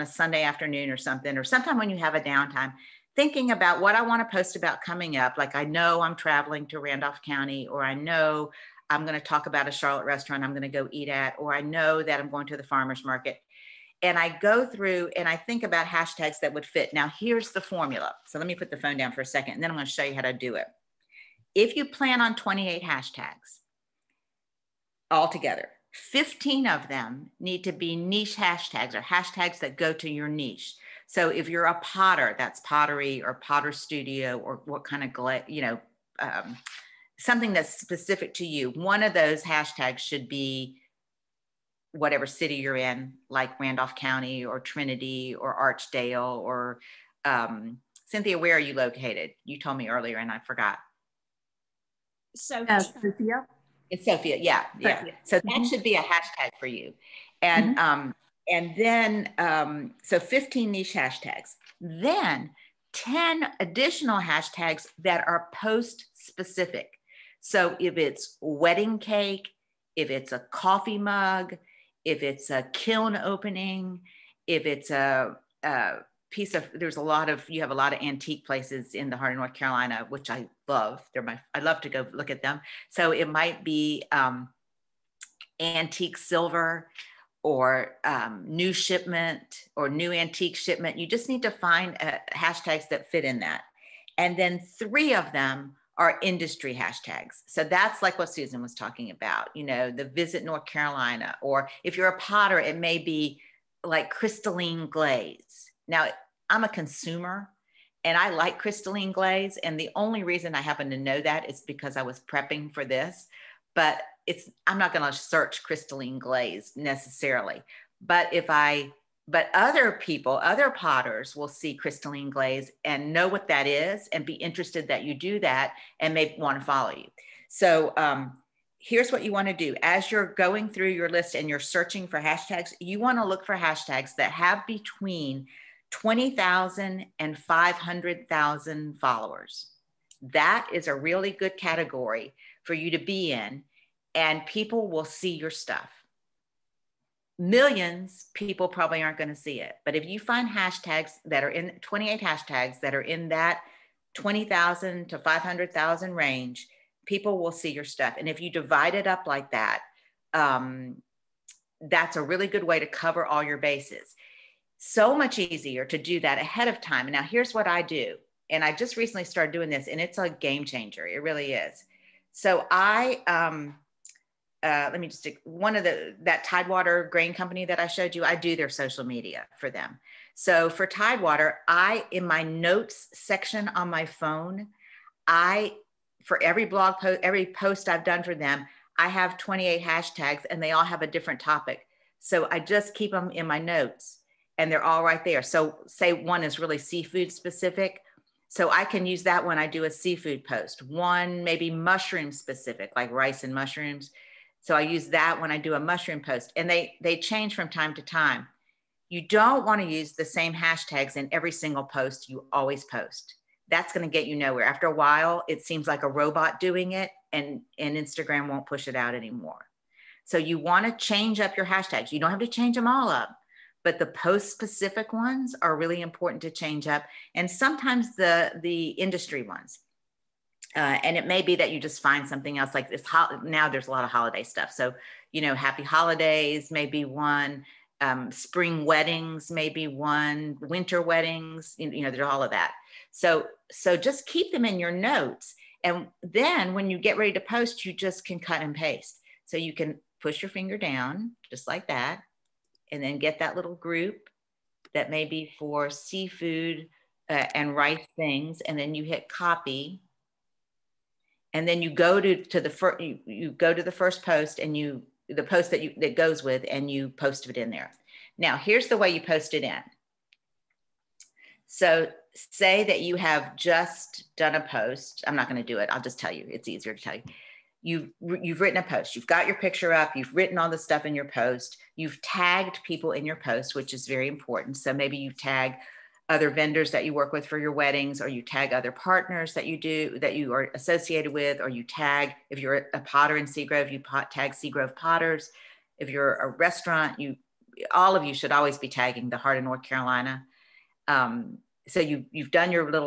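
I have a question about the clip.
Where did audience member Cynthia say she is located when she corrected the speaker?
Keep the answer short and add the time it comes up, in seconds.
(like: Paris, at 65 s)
Sophia, at 53 s.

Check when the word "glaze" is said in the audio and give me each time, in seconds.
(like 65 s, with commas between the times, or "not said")
104 s, 109 s, 116 s, 122 s.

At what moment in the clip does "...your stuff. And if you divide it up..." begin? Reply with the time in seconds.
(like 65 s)
157 s.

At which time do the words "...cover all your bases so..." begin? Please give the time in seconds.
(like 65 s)
162 s.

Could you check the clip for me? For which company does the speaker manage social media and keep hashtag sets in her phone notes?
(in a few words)
Tidewater Grain Company.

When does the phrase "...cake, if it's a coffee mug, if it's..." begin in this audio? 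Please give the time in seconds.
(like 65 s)
68 s.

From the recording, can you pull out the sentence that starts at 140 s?
That is a really good category for you to be in, and people will see your stuff.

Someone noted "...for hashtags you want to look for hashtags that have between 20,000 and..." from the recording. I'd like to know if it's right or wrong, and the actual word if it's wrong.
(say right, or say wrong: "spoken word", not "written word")
right.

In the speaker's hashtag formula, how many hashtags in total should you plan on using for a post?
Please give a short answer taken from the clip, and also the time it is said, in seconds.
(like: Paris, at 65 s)
28, at 22 s.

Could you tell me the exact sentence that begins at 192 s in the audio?
So I just keep them in my notes and they're all right there.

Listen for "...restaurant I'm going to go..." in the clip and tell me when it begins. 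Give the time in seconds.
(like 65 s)
10 s.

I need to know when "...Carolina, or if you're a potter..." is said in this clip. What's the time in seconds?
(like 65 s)
100 s.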